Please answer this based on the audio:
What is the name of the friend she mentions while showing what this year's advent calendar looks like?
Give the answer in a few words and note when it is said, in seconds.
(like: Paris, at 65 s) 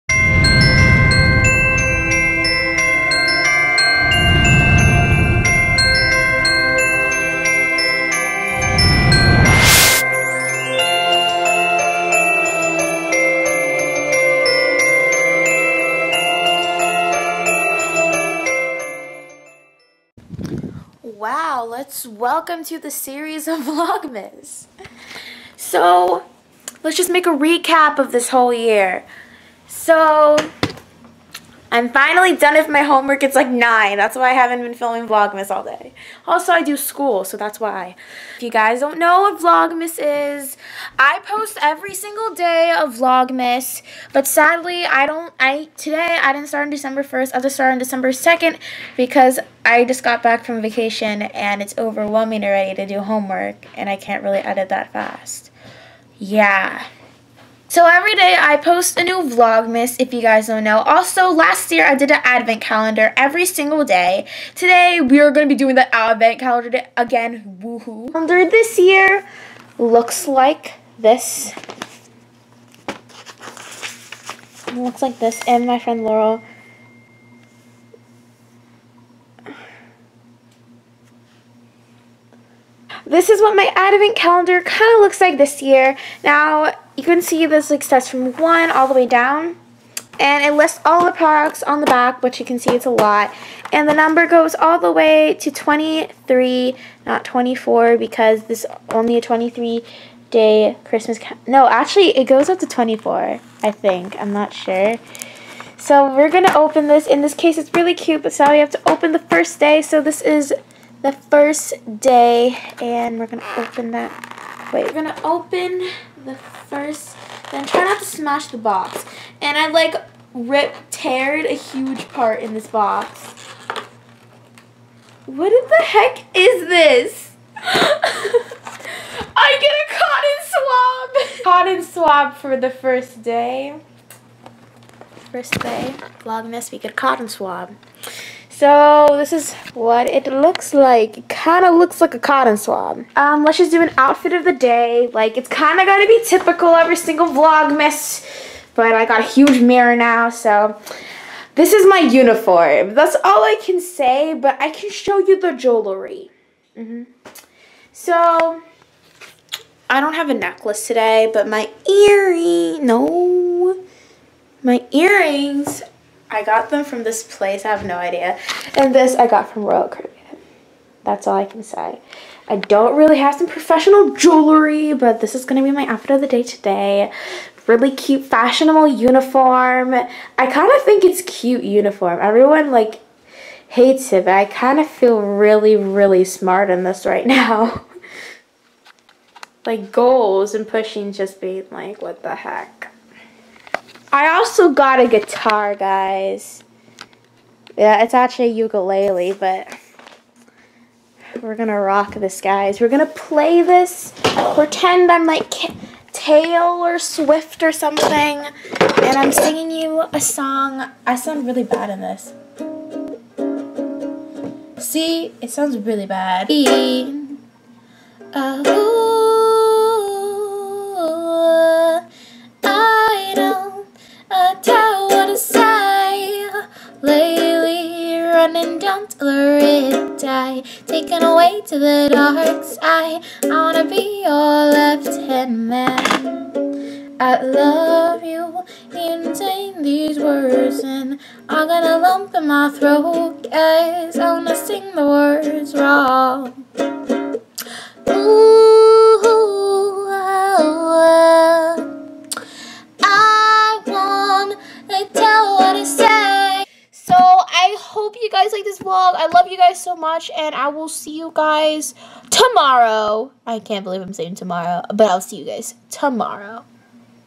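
Laurel, at 76 s.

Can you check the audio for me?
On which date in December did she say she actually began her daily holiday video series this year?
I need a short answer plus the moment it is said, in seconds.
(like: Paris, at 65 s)
December 2nd, at 47 s.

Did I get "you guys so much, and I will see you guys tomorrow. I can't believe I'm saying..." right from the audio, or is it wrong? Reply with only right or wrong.
right.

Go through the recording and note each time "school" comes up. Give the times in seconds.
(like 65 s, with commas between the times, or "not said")
36 s.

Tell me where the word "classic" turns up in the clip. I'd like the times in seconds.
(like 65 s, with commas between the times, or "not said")
not said.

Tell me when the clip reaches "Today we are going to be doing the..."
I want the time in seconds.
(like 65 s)
64 s.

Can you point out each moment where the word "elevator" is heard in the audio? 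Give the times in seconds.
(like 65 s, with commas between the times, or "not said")
not said.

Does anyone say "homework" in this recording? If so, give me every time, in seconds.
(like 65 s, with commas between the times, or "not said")
32 s, 52 s.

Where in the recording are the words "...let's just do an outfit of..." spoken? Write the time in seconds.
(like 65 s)
143 s.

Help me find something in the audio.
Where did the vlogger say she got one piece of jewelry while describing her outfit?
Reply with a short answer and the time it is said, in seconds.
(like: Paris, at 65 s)
Royal Caribbean, at 169 s.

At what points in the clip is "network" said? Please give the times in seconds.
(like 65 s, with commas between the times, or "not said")
not said.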